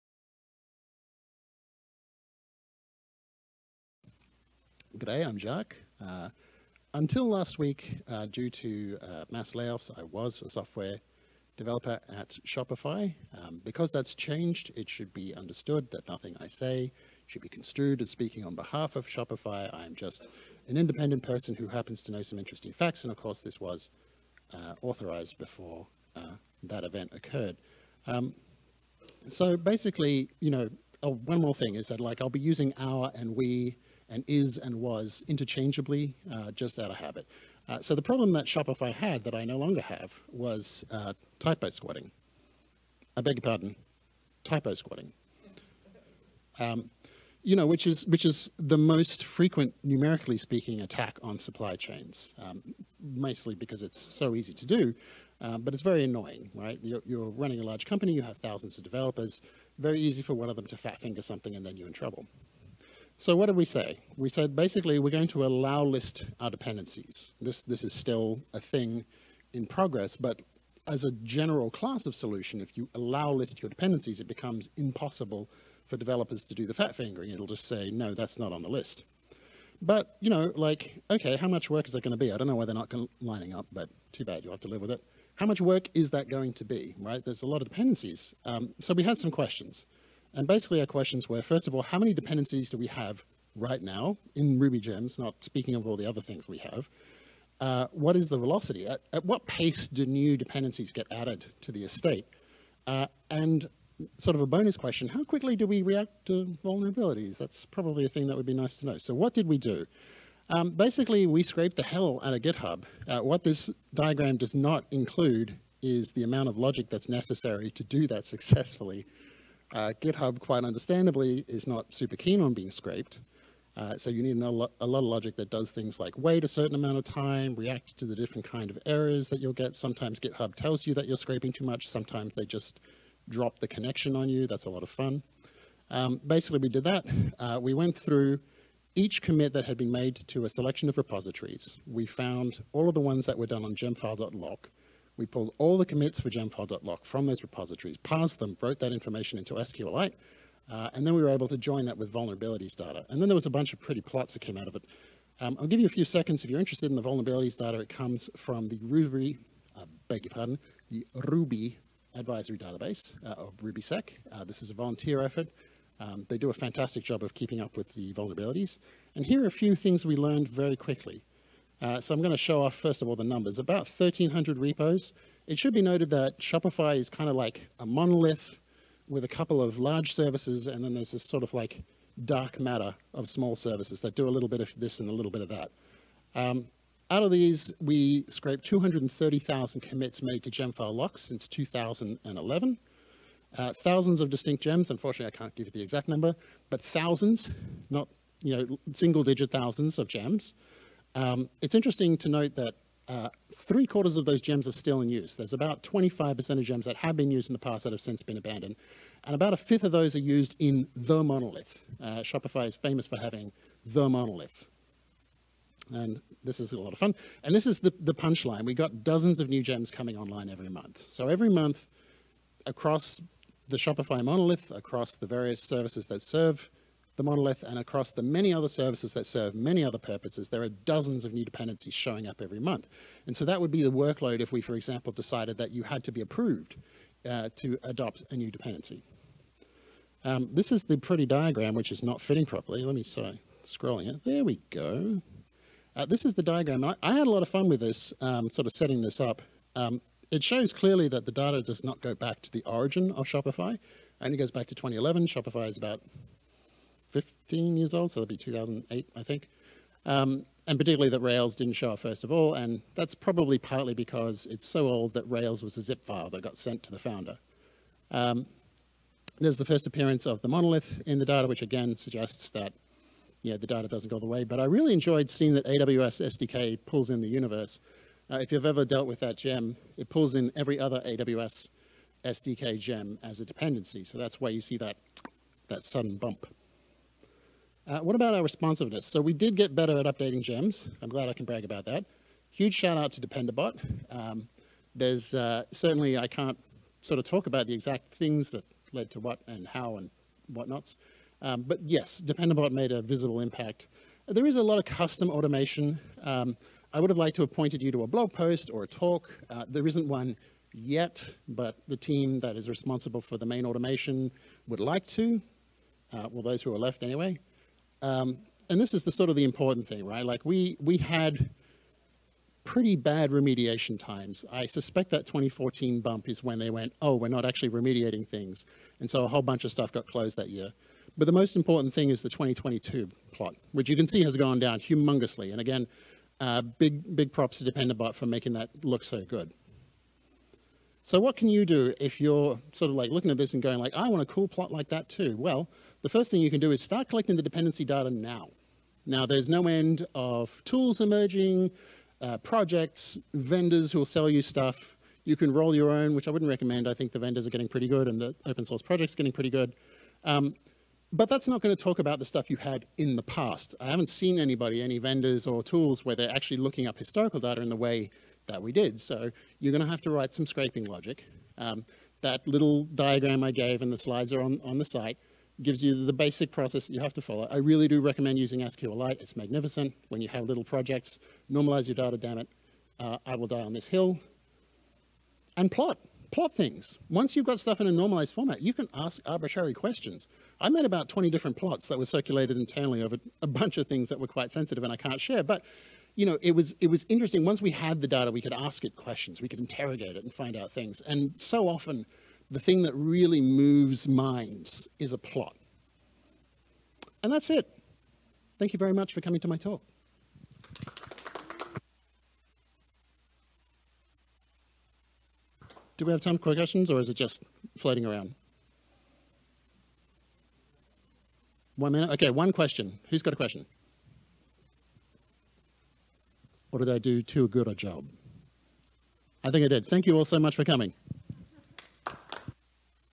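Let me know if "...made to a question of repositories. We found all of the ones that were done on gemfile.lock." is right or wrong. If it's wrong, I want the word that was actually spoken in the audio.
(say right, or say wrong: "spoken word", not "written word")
wrong: "selection", not "question".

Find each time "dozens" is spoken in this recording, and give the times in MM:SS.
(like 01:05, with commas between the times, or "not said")
03:39, 03:50.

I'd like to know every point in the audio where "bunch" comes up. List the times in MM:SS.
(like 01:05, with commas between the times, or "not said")
02:33, 05:29, 06:33.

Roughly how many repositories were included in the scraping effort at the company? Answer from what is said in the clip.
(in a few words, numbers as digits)
1,300.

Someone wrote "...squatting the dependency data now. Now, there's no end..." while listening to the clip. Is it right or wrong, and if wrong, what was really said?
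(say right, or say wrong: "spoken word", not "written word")
wrong: "collecting", not "squatting".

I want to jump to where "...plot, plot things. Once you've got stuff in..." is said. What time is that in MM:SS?
06:25.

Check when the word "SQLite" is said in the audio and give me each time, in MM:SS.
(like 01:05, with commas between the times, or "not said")
02:29, 06:18.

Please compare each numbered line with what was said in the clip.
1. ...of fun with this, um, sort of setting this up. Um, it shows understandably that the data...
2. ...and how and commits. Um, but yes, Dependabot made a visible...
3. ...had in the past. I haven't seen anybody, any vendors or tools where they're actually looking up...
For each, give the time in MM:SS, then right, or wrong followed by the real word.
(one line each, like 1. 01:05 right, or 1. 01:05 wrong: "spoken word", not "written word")
1. 04:07 wrong: "clearly", not "understandably"
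2. 04:59 wrong: "whatnots", not "commits"
3. 06:02 right.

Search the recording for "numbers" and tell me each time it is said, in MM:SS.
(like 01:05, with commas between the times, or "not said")
02:53, 03:16.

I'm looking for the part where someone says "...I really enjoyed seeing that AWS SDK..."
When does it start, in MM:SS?
04:34.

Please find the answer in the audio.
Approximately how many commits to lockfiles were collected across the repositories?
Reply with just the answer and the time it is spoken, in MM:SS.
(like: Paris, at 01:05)
230,000, at 03:08.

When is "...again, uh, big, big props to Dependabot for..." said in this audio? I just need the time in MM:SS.
05:35.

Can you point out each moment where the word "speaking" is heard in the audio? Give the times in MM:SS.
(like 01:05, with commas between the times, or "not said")
00:18, 00:50, 01:35.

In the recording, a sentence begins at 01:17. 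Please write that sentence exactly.
It'll just say, no, that's not on the list.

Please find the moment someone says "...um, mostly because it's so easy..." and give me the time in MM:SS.
00:52.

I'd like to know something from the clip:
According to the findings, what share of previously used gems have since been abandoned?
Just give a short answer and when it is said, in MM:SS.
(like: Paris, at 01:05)
25%, at 03:25.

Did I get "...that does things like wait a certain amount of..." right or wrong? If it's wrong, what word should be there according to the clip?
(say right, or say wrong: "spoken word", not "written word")
right.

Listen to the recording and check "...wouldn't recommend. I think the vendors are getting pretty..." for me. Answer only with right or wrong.
right.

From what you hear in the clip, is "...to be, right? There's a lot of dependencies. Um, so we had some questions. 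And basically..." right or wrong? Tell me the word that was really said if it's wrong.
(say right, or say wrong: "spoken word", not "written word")
right.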